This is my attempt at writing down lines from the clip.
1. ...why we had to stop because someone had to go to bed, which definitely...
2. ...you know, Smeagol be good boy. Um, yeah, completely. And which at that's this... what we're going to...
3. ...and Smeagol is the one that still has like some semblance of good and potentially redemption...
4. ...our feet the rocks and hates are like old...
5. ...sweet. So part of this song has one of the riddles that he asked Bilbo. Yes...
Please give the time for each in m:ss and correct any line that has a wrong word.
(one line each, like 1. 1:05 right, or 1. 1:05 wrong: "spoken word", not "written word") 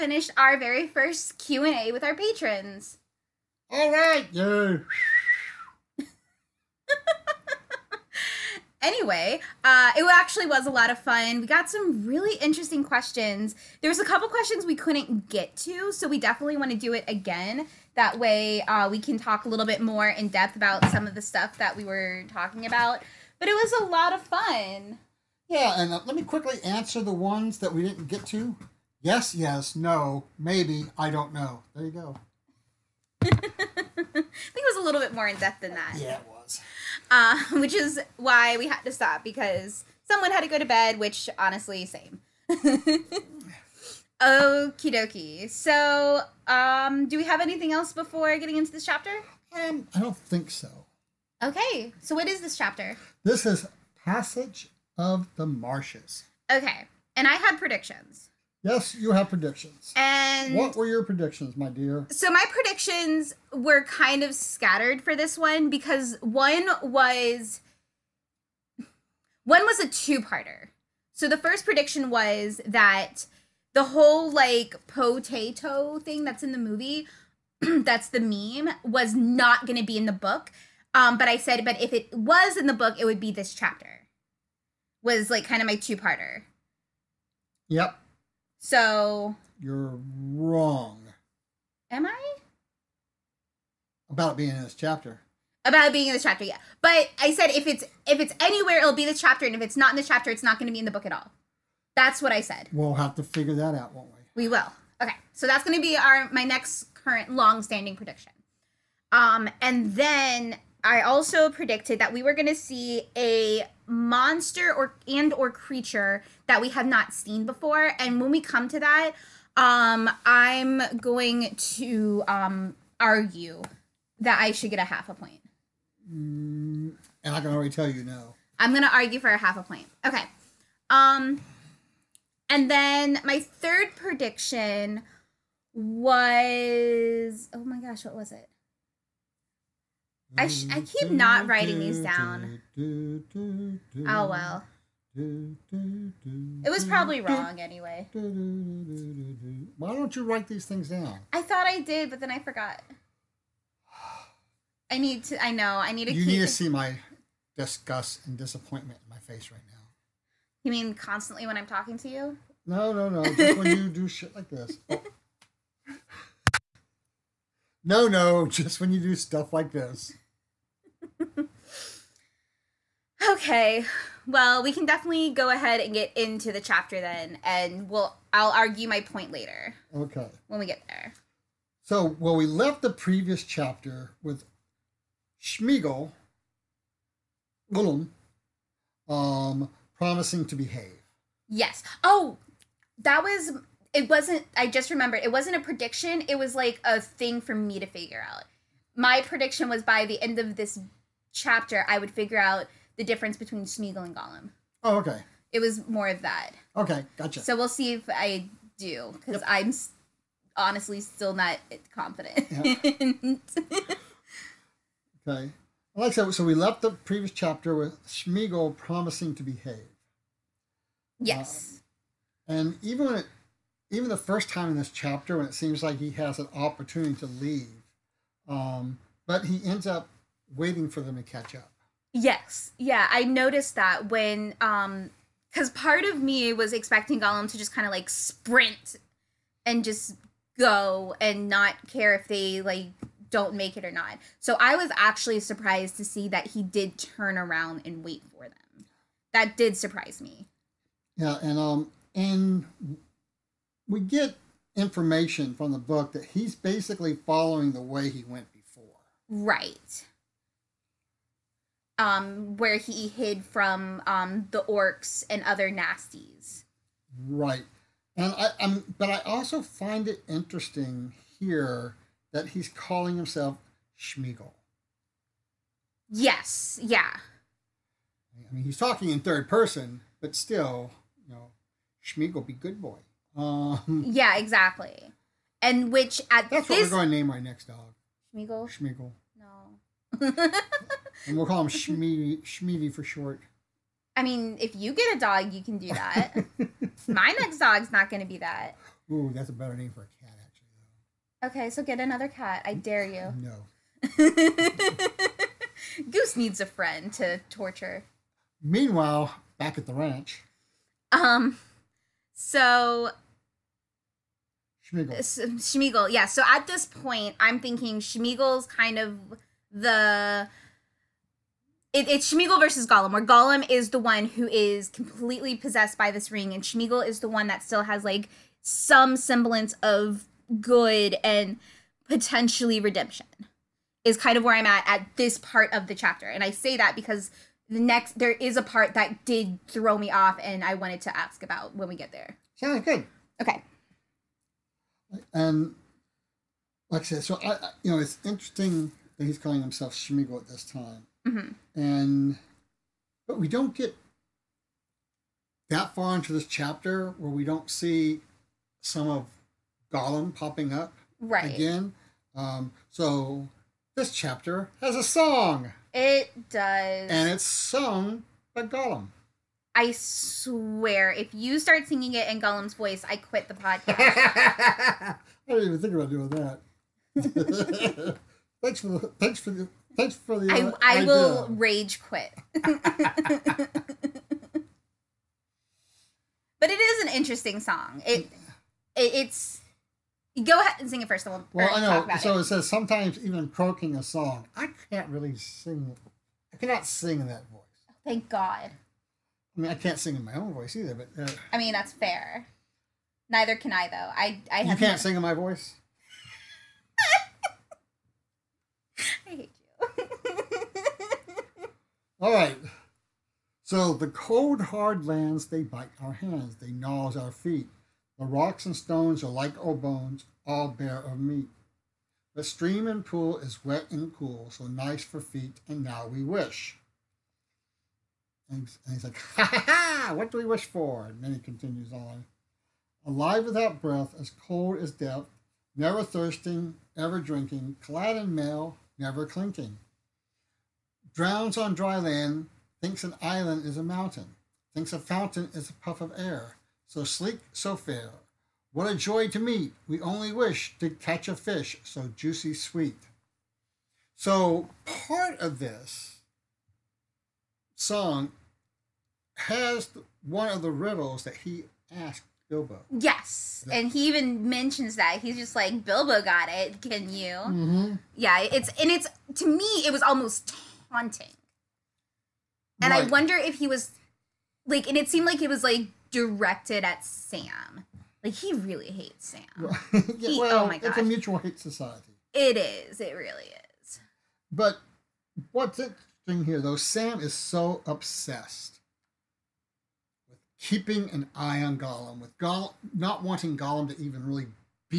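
1. 0:38 wrong: "honestly", not "definitely"
2. 4:41 wrong: "exactly", not "completely"
3. 5:26 right
4. 6:57 wrong: "stones", not "hates"
5. 7:32 right.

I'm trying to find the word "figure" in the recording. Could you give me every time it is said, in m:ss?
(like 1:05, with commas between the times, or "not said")
1:43, 3:17, 3:22.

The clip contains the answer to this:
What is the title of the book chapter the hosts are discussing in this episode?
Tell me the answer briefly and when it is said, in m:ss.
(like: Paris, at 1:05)
Passage of the Marshes, at 0:54.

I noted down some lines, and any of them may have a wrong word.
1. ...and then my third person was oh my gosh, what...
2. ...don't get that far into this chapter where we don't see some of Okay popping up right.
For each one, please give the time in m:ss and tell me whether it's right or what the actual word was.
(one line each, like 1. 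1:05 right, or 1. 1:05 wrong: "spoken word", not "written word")
1. 2:12 wrong: "prediction", not "person"
2. 5:53 wrong: "Gollum", not "Okay".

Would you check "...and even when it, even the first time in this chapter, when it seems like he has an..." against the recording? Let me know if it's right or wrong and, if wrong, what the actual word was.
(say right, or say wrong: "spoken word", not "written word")
right.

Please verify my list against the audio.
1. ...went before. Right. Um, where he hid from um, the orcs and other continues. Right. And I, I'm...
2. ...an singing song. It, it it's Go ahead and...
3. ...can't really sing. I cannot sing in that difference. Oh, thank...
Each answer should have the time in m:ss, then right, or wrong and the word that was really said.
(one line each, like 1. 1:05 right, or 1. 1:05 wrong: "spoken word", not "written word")
1. 4:18 wrong: "nasties", not "continues"
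2. 6:27 wrong: "interesting", not "singing"
3. 6:34 wrong: "voice", not "difference".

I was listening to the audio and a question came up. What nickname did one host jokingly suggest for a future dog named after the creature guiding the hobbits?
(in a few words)
Schmeedy.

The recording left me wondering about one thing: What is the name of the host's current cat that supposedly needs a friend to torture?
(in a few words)
Goose.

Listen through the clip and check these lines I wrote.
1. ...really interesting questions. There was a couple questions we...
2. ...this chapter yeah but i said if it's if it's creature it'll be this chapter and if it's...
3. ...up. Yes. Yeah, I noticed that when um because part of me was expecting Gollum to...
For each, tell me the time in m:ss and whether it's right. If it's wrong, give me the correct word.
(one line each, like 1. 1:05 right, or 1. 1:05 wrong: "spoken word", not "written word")
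1. 0:12 right
2. 1:36 wrong: "anywhere", not "creature"
3. 3:51 right.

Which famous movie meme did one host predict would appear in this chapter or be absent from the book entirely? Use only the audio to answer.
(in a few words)
potato.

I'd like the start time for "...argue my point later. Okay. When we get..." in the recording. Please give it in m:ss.
2:58.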